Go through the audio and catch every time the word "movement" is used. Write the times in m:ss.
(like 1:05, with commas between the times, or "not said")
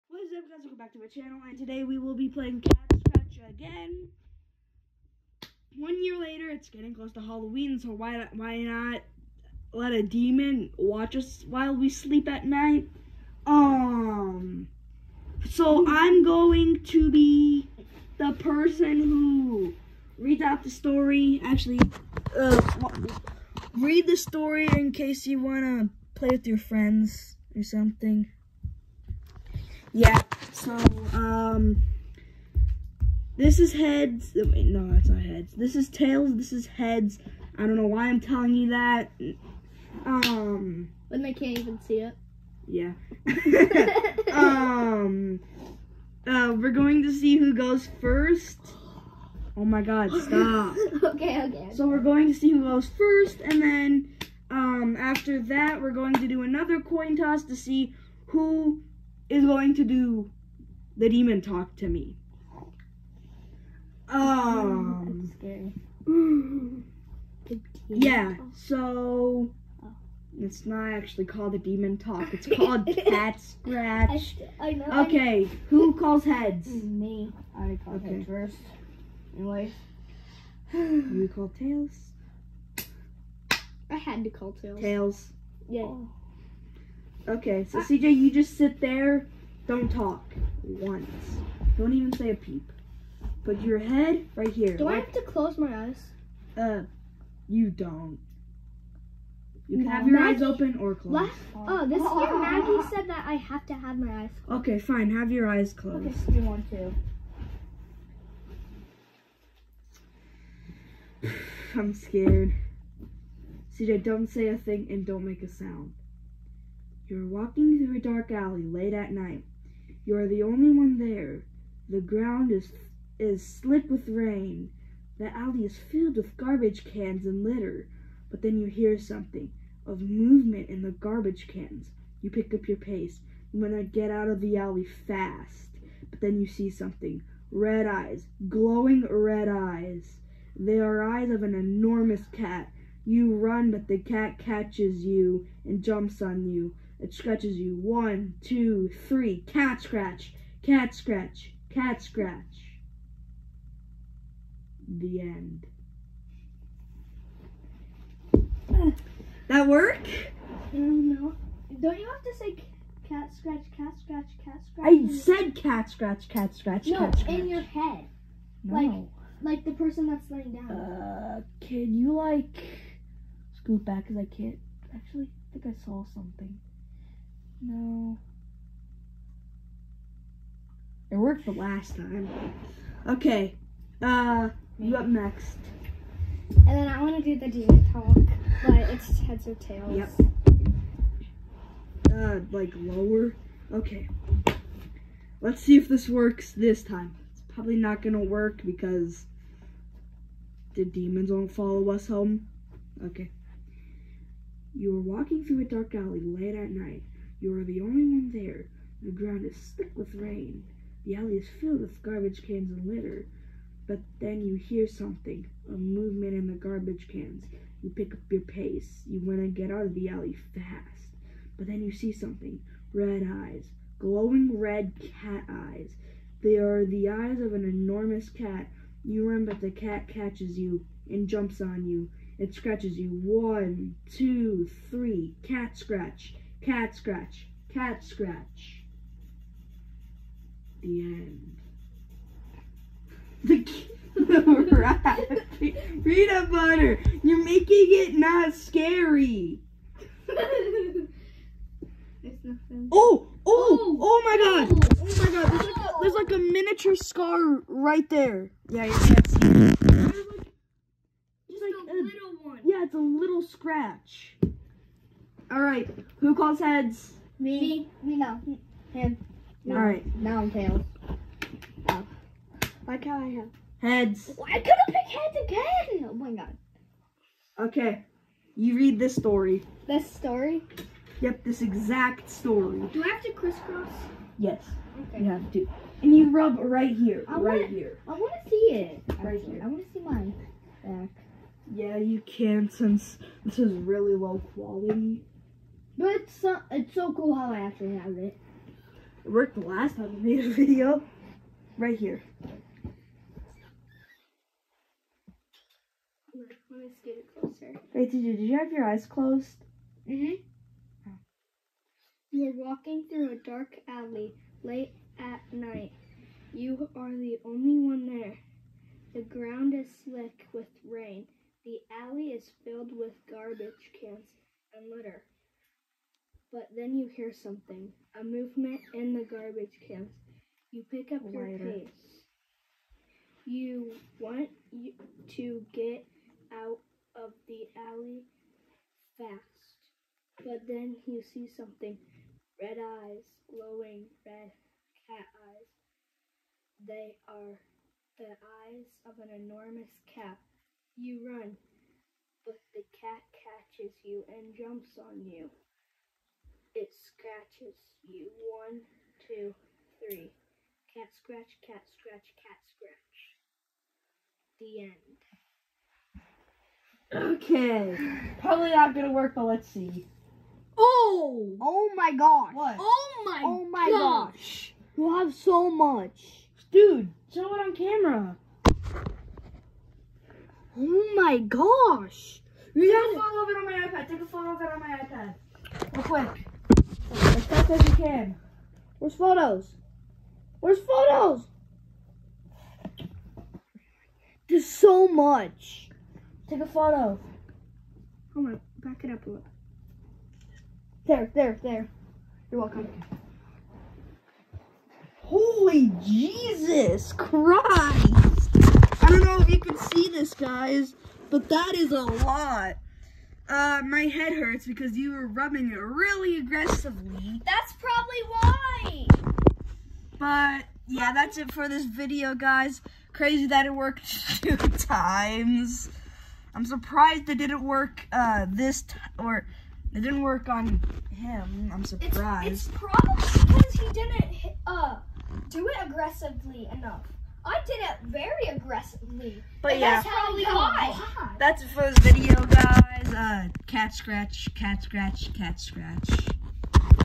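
2:10, 3:35, 5:28.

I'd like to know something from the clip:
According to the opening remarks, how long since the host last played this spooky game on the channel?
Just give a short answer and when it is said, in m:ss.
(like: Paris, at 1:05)
One year, at 0:05.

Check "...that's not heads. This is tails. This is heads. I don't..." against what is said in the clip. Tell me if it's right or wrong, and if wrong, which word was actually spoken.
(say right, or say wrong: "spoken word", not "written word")
right.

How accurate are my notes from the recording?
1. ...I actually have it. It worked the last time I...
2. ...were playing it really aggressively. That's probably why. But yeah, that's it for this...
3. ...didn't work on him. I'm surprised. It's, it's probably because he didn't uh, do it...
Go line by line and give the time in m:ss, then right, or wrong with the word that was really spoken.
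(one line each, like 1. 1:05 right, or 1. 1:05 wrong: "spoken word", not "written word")
1. 4:57 right
2. 6:55 wrong: "rubbing", not "playing"
3. 7:09 right.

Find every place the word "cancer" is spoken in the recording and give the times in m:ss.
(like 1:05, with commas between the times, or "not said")
not said.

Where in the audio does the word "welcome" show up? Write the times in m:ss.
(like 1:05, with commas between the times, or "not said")
0:00, 6:42.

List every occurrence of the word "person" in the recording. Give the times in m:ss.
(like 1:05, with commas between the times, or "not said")
0:18, 2:49.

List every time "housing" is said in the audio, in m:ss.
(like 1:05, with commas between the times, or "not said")
not said.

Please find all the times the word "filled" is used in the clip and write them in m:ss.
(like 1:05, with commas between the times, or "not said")
2:05, 3:31, 5:22.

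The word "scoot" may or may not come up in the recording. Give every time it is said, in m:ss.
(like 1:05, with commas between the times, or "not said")
2:53, 5:06.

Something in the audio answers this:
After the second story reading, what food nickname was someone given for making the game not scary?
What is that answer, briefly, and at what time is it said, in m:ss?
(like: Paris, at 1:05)
Peanut butter, at 4:06.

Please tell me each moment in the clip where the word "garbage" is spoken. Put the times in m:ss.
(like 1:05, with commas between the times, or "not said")
2:06, 2:10, 3:32, 3:36, 5:23, 5:29.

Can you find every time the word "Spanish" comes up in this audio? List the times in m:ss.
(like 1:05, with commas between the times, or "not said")
not said.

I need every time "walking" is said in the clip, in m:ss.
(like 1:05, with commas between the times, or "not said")
1:57, 3:25, 5:12.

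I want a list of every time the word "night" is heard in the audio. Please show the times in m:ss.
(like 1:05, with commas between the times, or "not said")
0:12, 1:59, 3:26, 5:15.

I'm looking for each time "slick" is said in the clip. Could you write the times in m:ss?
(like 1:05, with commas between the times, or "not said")
2:03, 3:29, 5:20.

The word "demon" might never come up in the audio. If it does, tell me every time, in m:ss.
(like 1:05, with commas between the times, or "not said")
0:10, 1:01, 1:11, 3:07, 3:20.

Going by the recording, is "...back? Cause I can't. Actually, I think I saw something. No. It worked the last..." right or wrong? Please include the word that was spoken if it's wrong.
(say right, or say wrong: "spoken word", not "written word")
right.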